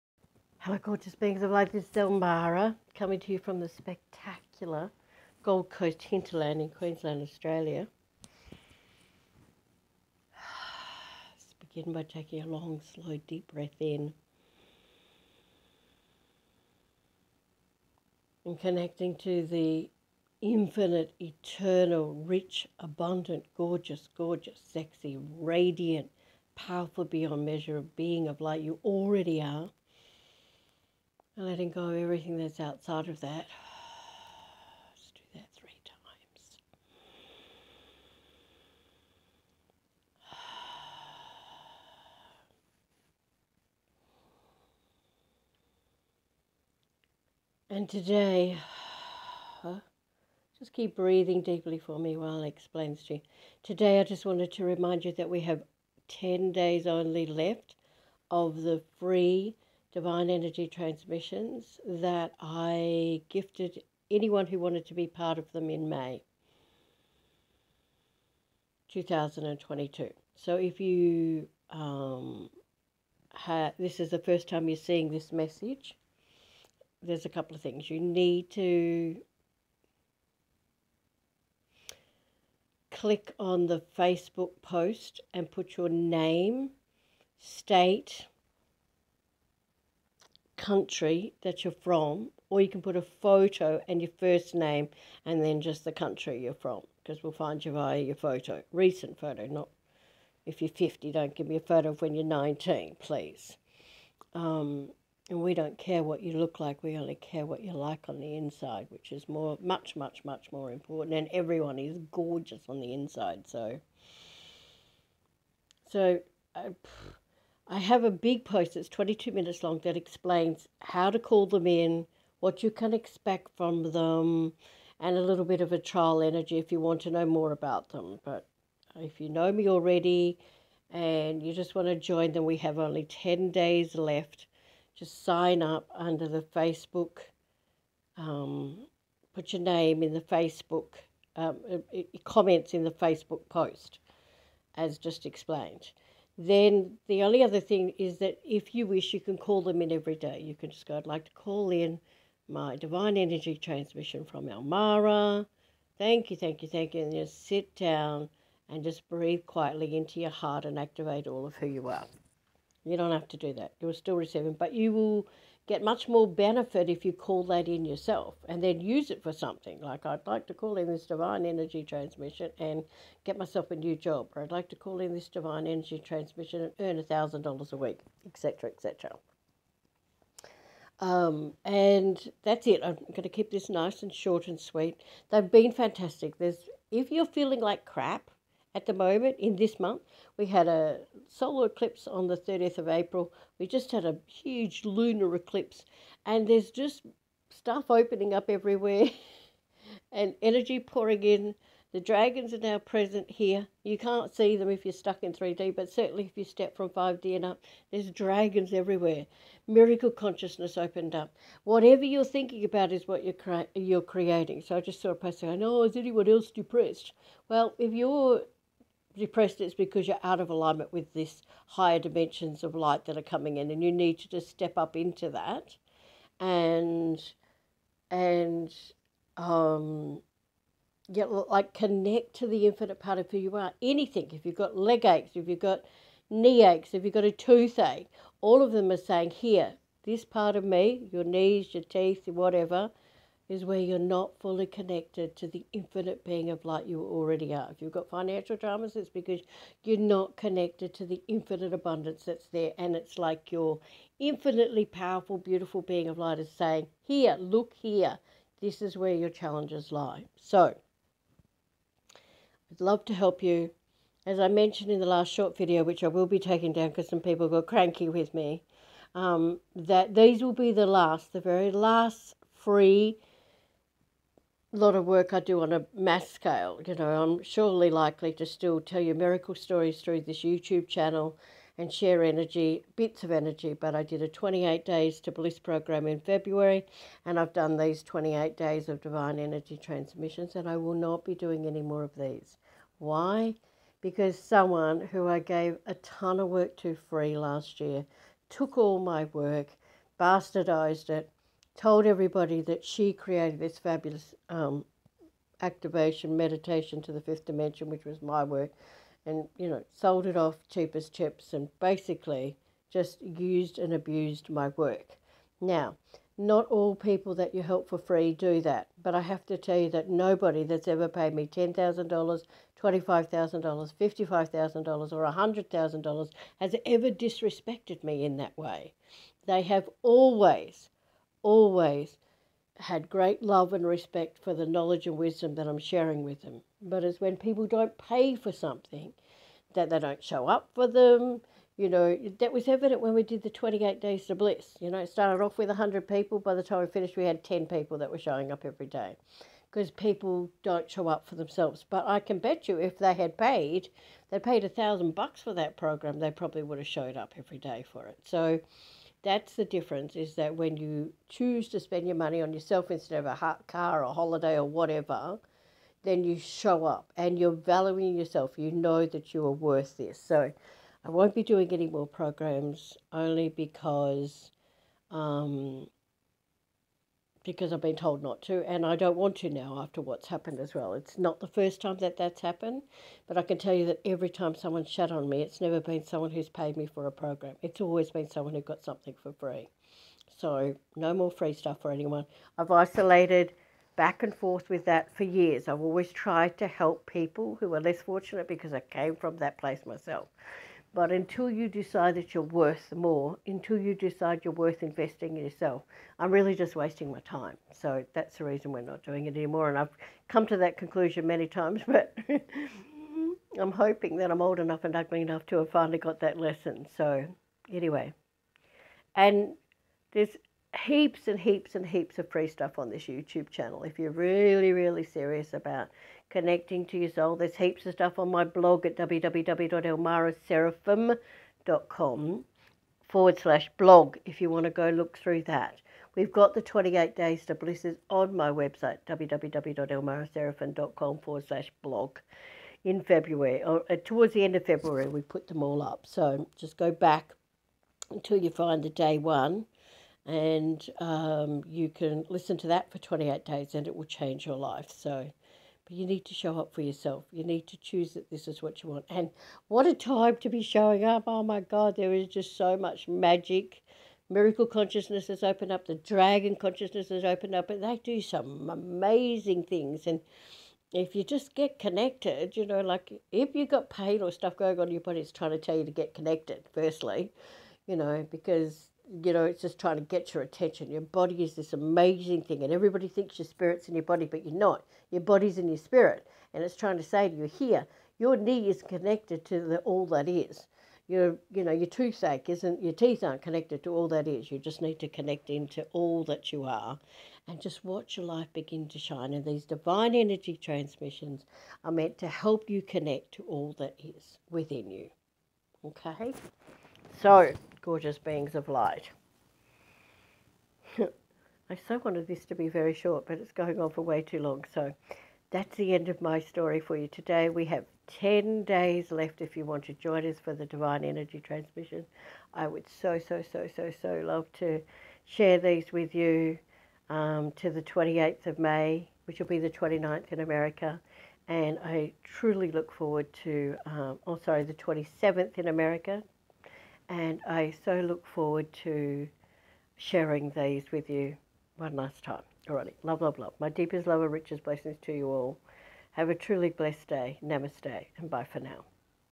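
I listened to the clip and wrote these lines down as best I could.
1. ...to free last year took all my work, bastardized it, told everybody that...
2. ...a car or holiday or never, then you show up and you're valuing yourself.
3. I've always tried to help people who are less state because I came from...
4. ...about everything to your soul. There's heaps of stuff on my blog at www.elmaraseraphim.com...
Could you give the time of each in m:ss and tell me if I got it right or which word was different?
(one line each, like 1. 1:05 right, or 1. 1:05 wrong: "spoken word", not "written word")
1. 4:56 right
2. 6:03 wrong: "whatever", not "never"
3. 6:35 wrong: "fortunate", not "state"
4. 7:05 wrong: "connecting", not "everything".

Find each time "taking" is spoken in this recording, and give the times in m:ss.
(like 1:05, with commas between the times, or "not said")
0:12, 4:26.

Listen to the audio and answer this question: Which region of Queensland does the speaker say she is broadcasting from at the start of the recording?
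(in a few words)
Gold Coast hinterland.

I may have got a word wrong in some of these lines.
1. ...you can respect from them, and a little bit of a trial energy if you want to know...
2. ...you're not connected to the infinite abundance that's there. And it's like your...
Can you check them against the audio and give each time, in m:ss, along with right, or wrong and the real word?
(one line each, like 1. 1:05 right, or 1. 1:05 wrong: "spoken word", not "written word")
1. 2:02 wrong: "expect", not "respect"
2. 4:09 right.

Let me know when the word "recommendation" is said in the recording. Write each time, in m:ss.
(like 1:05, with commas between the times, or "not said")
not said.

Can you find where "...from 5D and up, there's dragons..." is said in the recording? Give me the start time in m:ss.
3:26.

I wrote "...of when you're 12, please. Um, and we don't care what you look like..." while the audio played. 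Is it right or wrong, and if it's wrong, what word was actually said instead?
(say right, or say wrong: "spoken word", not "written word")
wrong: "19", not "12".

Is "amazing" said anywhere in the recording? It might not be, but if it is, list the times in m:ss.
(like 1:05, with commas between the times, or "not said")
7:48, 8:01.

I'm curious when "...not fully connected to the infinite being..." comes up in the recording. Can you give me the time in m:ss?
4:03.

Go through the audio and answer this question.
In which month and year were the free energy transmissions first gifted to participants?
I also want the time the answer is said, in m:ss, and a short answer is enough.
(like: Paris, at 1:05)
May 2022, at 1:05.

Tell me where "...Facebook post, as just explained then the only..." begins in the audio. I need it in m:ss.
2:22.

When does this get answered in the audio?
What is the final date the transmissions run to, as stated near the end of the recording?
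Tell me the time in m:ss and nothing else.
8:47.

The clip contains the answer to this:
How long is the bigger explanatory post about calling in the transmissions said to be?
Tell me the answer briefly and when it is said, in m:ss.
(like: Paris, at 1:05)
22 minutes, at 1:58.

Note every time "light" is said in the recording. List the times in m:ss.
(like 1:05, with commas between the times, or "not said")
0:01, 0:28, 3:42, 4:06, 4:16, 8:28.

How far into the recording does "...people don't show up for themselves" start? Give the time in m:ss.
5:49.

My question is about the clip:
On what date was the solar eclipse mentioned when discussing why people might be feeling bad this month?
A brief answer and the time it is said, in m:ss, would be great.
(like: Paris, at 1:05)
30 April, at 3:12.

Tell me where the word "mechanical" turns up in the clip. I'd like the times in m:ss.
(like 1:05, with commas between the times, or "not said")
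not said.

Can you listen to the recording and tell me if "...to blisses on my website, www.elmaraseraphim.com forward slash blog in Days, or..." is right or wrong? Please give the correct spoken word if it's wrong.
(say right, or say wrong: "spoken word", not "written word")
wrong: "February", not "Days".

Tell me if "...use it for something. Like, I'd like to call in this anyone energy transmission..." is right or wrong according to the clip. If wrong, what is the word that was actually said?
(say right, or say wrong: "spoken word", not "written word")
wrong: "divine", not "anyone".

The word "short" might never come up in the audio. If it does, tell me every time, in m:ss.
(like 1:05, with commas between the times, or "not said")
3:04, 4:25, 8:32.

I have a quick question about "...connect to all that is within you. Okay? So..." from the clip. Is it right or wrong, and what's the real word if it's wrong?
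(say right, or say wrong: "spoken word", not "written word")
right.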